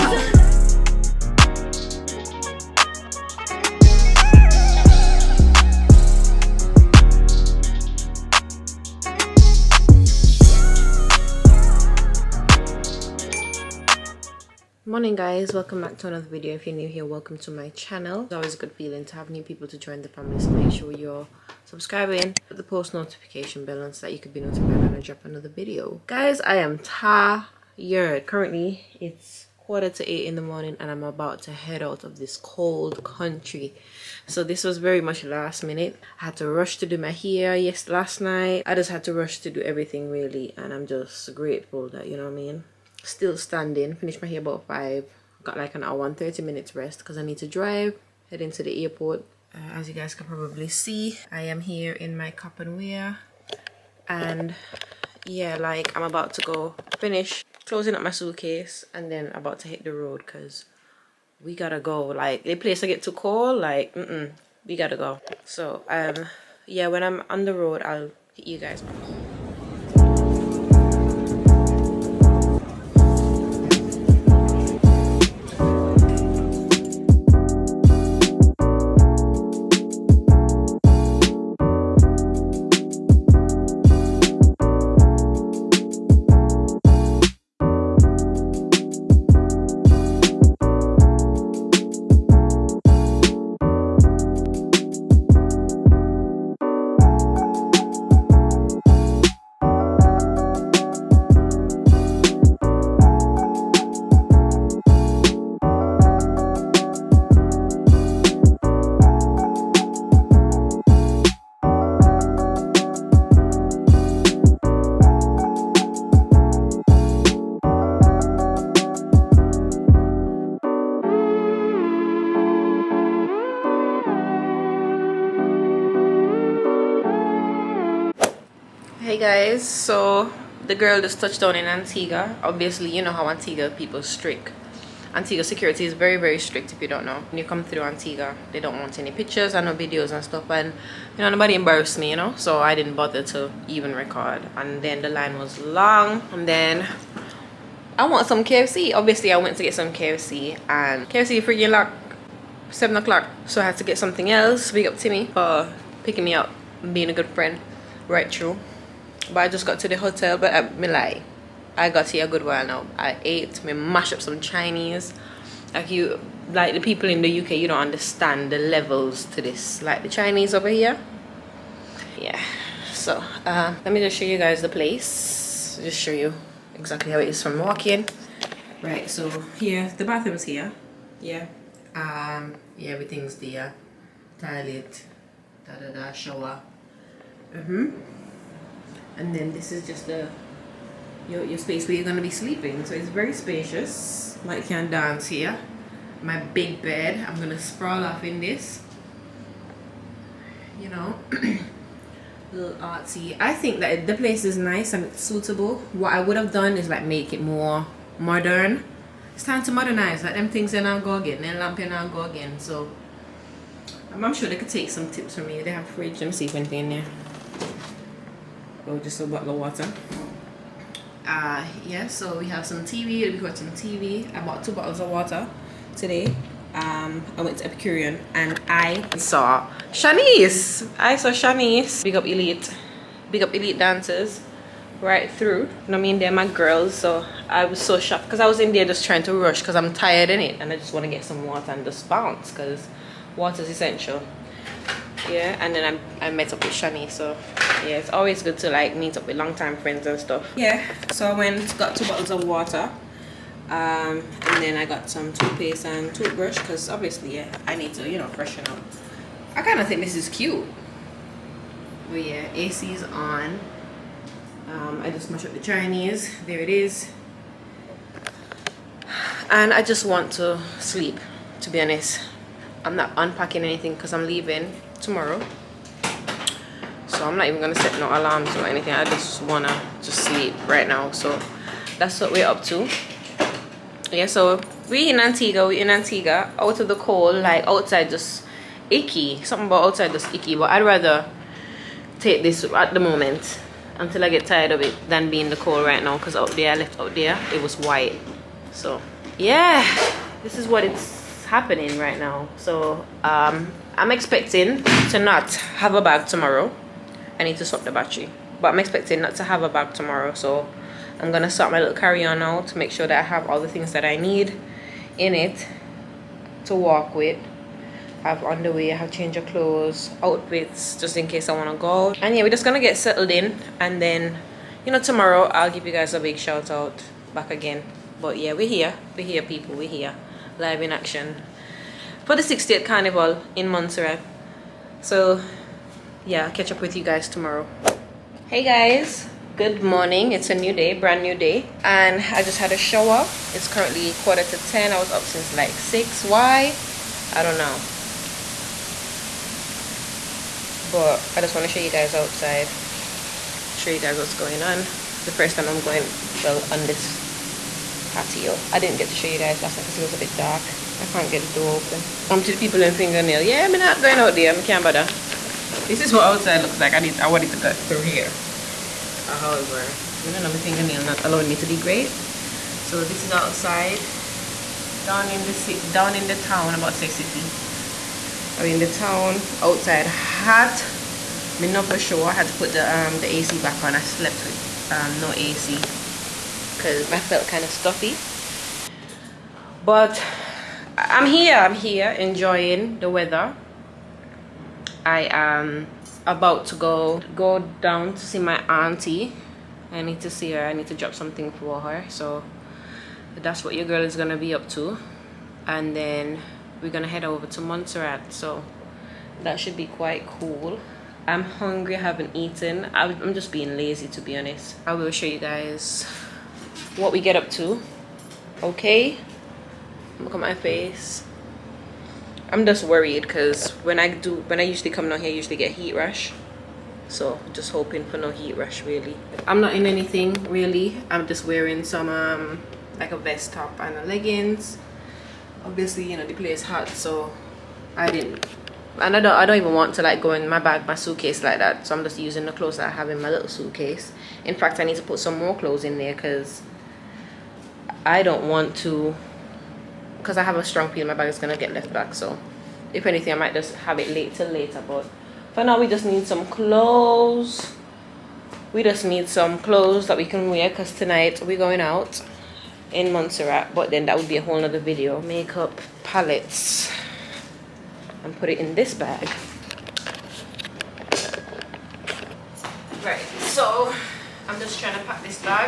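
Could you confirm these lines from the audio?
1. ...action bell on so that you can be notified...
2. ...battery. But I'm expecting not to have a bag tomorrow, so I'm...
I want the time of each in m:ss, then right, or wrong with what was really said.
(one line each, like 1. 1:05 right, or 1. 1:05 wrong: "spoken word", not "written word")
1. 0:22 wrong: "notification", not "action"
2. 5:07 right.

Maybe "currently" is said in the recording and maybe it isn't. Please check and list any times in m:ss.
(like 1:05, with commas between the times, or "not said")
0:28, 5:43.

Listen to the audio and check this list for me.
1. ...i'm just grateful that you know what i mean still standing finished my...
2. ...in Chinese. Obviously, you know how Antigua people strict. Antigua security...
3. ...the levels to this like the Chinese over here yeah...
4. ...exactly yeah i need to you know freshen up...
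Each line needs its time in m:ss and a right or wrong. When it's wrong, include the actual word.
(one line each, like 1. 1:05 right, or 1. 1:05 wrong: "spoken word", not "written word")
1. 0:40 right
2. 2:11 wrong: "Antigua", not "Chinese"
3. 2:48 right
4. 4:16 wrong: "obviously", not "exactly".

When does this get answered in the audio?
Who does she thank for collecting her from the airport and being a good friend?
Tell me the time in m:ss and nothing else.
2:34.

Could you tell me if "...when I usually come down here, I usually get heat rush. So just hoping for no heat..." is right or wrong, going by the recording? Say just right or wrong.
right.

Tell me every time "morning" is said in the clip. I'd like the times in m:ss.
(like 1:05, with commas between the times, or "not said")
0:14, 0:30, 5:39.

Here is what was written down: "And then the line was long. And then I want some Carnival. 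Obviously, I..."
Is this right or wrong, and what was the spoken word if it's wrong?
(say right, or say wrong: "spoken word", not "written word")
wrong: "KFC", not "Carnival".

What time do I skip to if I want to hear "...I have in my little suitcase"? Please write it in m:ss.
7:22.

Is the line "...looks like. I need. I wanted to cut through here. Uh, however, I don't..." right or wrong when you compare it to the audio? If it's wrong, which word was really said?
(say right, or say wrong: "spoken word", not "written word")
right.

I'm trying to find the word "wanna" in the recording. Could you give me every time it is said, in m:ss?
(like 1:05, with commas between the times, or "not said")
4:39, 5:21.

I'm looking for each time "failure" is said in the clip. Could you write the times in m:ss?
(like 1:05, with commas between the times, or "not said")
not said.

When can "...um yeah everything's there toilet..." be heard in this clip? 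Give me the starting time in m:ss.
3:01.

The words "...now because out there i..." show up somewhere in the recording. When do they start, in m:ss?
4:56.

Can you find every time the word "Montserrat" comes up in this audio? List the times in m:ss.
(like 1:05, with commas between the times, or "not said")
5:33, 6:47, 7:43.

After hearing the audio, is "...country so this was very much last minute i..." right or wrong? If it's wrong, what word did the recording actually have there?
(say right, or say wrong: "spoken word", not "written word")
right.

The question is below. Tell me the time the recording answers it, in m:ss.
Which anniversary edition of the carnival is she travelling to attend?
5:32.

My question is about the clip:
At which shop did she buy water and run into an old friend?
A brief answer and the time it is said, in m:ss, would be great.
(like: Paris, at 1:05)
Epicurean, at 3:47.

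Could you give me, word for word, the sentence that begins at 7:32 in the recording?
So if anything, I might just have it later.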